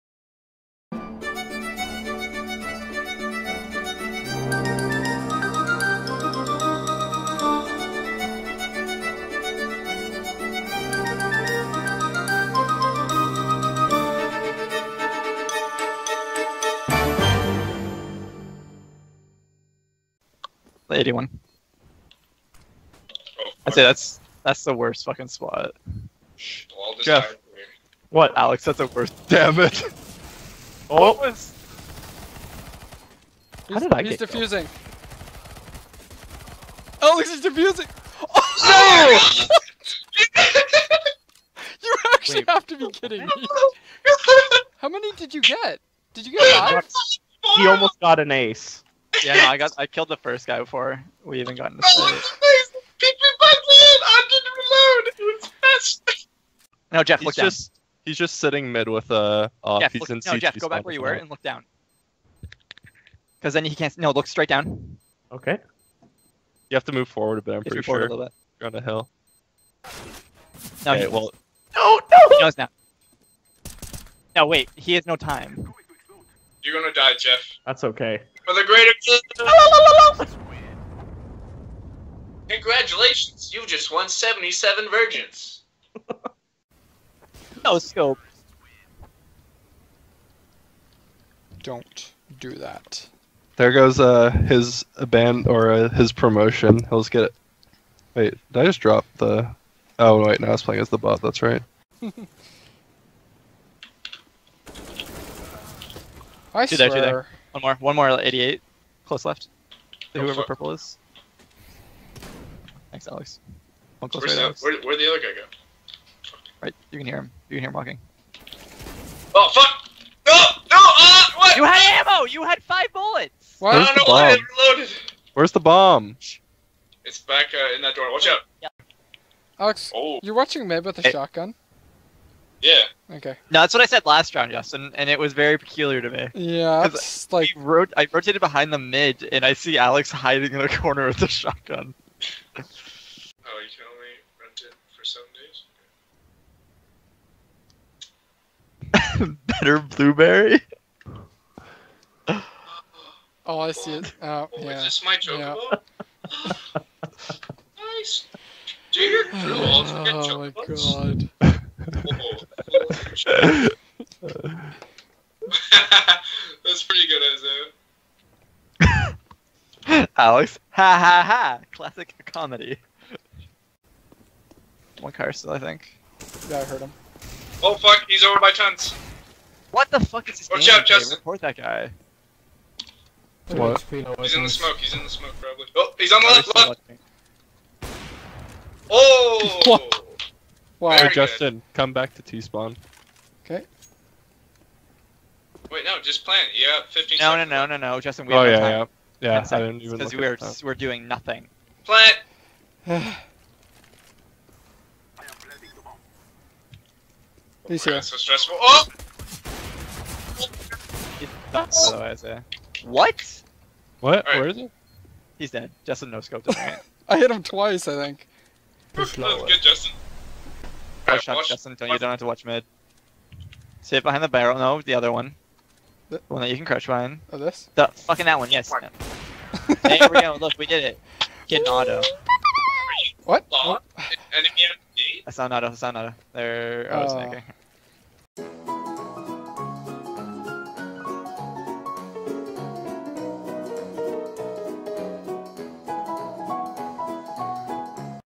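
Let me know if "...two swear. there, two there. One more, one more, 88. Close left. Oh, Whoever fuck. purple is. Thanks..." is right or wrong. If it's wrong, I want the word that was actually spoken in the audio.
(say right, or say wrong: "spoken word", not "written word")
right.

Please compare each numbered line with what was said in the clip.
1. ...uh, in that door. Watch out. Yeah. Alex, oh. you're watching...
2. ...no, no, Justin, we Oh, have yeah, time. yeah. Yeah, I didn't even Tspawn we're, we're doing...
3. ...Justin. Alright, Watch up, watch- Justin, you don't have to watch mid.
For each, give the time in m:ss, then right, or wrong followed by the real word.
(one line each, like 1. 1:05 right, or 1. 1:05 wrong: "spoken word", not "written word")
1. 2:07 right
2. 3:17 wrong: "Because", not "Tspawn"
3. 3:39 right.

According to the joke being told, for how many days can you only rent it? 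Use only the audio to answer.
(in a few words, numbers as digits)
7.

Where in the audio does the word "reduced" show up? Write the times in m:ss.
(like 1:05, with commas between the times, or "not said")
not said.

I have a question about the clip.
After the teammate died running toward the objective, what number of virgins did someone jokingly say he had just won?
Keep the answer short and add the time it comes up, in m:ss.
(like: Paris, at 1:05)
77, at 1:24.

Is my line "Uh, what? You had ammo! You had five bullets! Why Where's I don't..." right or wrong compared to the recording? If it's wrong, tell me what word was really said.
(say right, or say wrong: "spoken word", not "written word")
right.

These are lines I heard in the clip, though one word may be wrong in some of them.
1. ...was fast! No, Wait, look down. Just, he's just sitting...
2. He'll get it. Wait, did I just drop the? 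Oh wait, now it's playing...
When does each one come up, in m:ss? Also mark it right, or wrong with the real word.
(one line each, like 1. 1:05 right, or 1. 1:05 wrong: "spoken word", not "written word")
1. 0:55 wrong: "Jeff", not "Wait"
2. 1:36 right.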